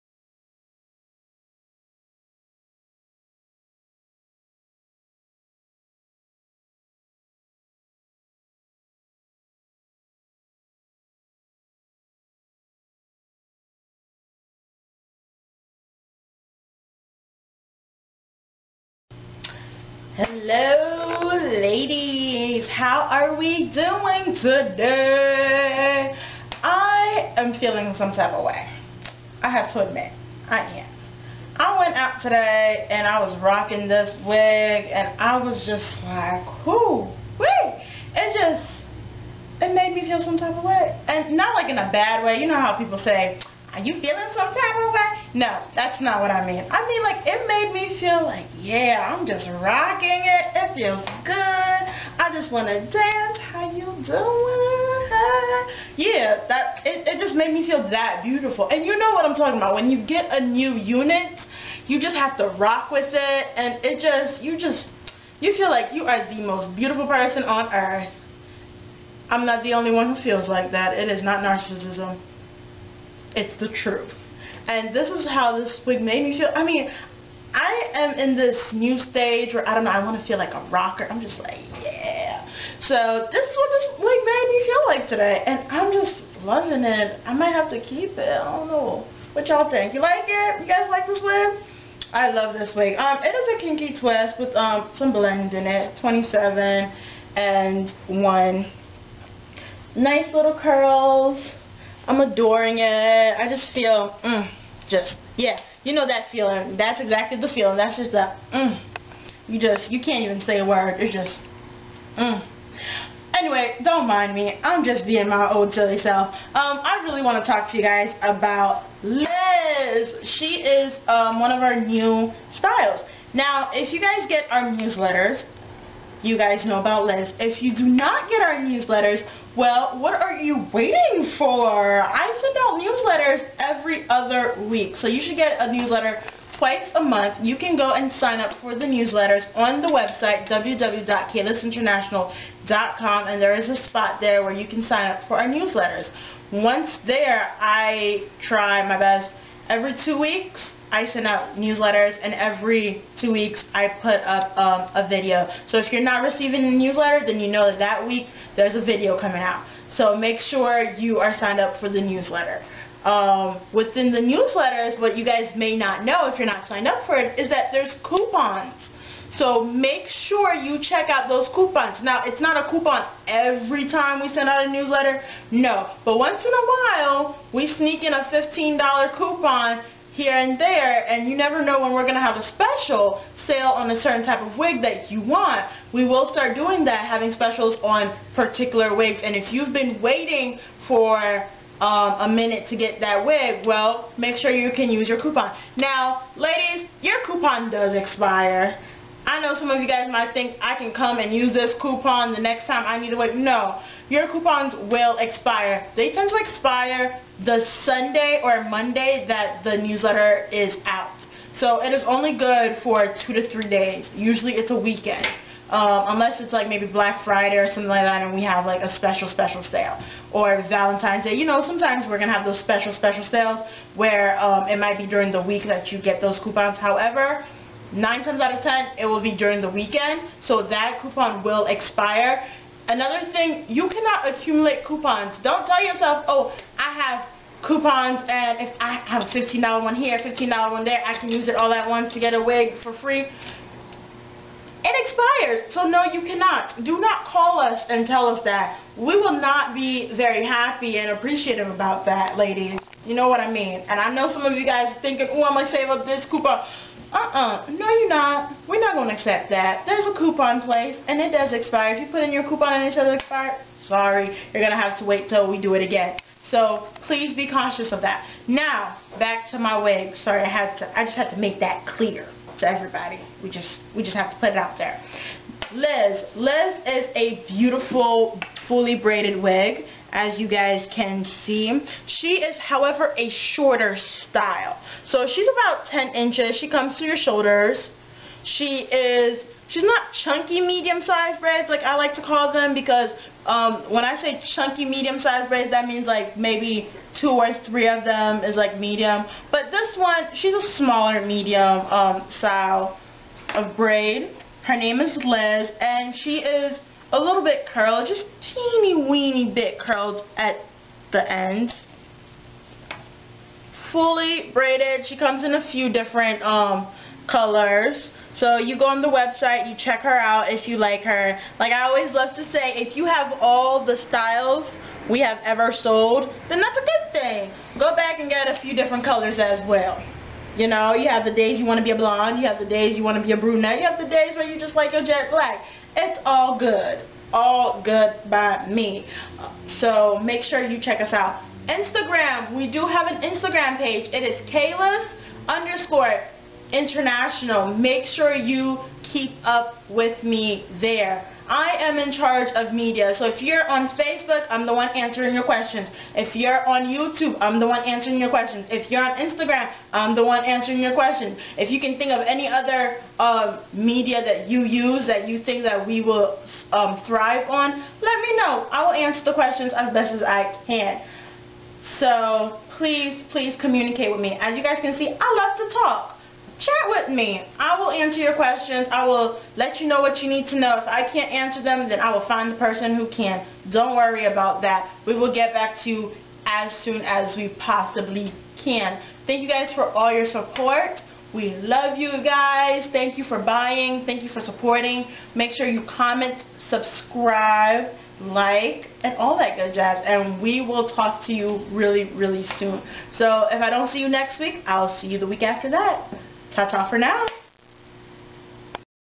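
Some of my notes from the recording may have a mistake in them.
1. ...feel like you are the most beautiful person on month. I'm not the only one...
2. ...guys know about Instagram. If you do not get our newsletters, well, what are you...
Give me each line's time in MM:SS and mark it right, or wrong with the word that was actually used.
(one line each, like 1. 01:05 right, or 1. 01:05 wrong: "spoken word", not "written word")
1. 01:05 wrong: "earth", not "month"
2. 02:06 wrong: "Liz", not "Instagram".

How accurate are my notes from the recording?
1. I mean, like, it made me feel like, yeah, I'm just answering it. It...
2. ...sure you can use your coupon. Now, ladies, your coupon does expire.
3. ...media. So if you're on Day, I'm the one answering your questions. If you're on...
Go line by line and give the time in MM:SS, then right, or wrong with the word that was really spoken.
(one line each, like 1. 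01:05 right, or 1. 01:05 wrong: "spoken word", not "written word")
1. 00:46 wrong: "rocking", not "answering"
2. 03:14 right
3. 05:52 wrong: "Facebook", not "Day".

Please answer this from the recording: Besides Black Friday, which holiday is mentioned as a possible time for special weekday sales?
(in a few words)
Valentine's Day.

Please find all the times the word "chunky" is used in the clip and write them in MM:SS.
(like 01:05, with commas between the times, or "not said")
04:50, 04:54.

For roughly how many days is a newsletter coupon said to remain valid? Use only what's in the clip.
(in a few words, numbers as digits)
2 to 3 days.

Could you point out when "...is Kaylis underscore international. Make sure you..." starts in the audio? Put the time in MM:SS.
05:44.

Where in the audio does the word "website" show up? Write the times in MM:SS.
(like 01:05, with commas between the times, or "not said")
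02:19, 05:19.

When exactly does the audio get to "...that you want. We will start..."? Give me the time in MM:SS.
03:04.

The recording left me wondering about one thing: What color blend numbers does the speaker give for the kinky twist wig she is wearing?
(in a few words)
27 and 1.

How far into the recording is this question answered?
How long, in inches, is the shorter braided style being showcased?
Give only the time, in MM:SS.
04:45.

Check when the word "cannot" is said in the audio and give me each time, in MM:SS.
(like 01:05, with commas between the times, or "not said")
03:53, 04:06.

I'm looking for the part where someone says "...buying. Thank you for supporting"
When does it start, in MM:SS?
06:33.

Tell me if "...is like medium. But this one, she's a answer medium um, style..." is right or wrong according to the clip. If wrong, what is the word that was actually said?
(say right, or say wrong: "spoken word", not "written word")
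wrong: "smaller", not "answer".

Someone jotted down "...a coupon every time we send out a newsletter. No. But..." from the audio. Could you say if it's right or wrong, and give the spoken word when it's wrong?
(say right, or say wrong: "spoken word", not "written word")
right.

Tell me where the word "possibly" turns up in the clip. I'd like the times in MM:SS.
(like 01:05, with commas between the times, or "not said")
06:27.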